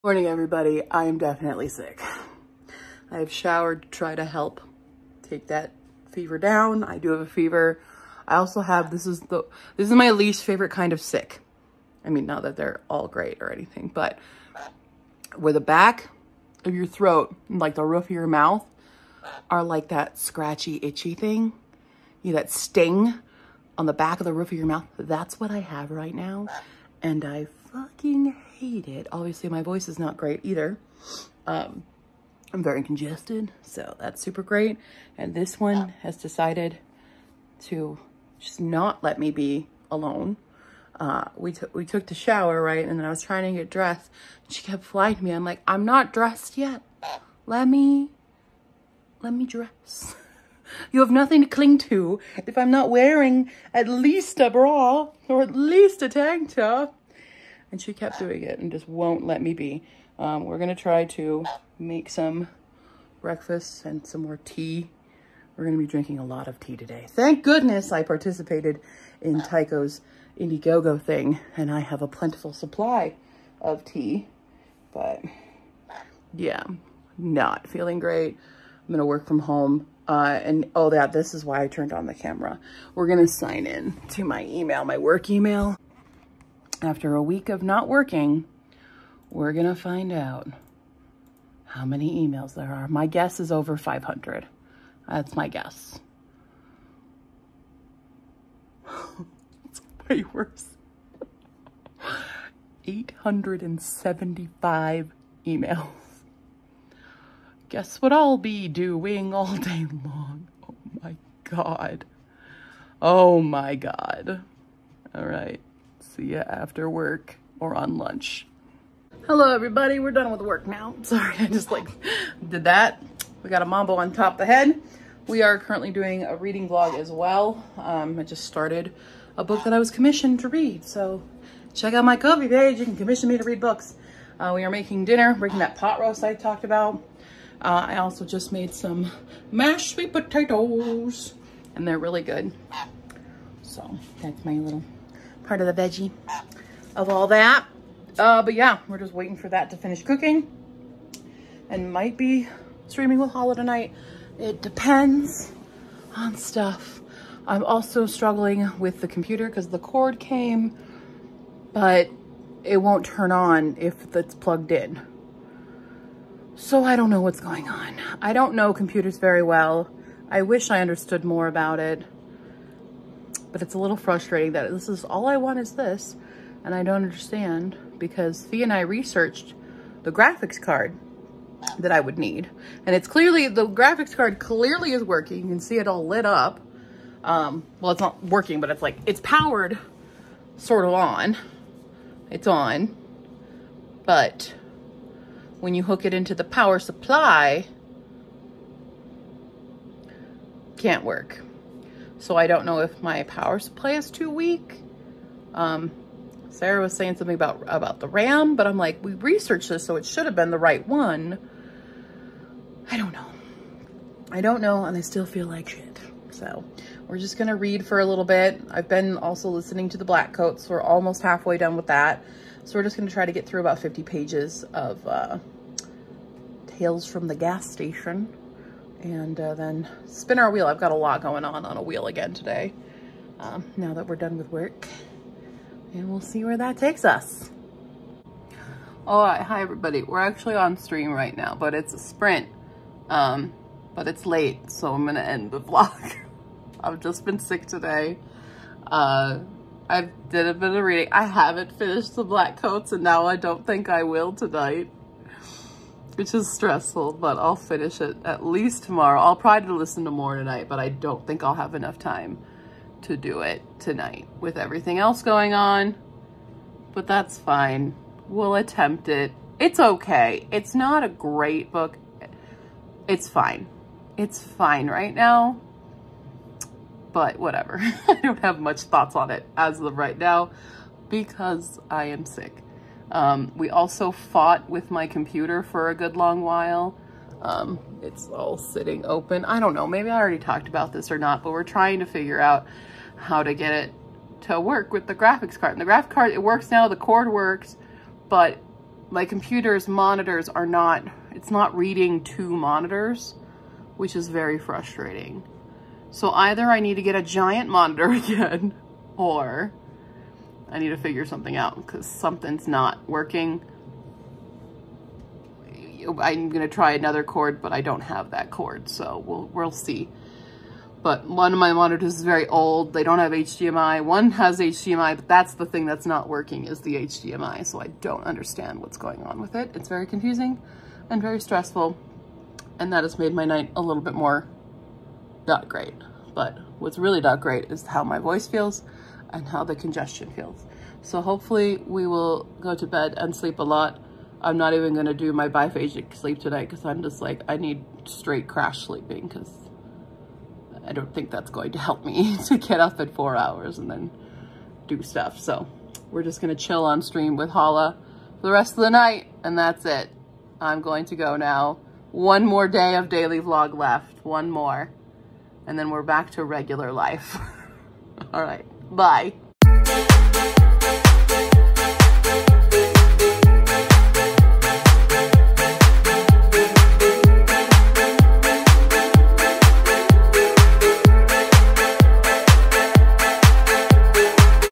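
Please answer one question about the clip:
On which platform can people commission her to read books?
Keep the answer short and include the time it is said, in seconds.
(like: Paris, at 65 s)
Ko-fi, at 132 s.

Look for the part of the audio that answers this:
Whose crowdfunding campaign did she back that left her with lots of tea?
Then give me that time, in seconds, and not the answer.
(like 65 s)
69 s.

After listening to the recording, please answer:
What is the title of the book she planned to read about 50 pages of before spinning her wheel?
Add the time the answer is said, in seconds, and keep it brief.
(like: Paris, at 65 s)
Tales from the Gas Station, at 226 s.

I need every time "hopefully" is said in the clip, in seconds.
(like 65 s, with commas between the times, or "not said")
341 s.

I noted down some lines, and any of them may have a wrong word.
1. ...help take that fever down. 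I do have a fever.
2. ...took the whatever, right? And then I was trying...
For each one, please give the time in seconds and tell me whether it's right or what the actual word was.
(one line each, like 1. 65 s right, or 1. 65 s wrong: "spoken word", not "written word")
1. 4 s right
2. 41 s wrong: "shower", not "whatever".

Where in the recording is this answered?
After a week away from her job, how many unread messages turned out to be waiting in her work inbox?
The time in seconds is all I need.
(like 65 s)
102 s.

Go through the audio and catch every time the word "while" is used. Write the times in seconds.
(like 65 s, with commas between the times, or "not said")
286 s.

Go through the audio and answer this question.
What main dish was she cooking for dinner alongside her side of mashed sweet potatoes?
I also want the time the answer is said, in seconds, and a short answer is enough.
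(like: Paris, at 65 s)
pot roast, at 135 s.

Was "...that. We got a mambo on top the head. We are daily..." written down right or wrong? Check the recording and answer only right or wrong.
wrong.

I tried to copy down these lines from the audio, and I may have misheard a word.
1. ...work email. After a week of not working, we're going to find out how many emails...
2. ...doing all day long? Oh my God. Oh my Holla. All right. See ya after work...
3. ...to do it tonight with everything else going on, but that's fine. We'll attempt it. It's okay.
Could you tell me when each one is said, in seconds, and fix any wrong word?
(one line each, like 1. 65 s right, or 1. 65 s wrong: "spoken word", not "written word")
1. 84 s right
2. 108 s wrong: "God", not "Holla"
3. 263 s right.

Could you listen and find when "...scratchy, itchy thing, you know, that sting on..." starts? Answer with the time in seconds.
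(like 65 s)
20 s.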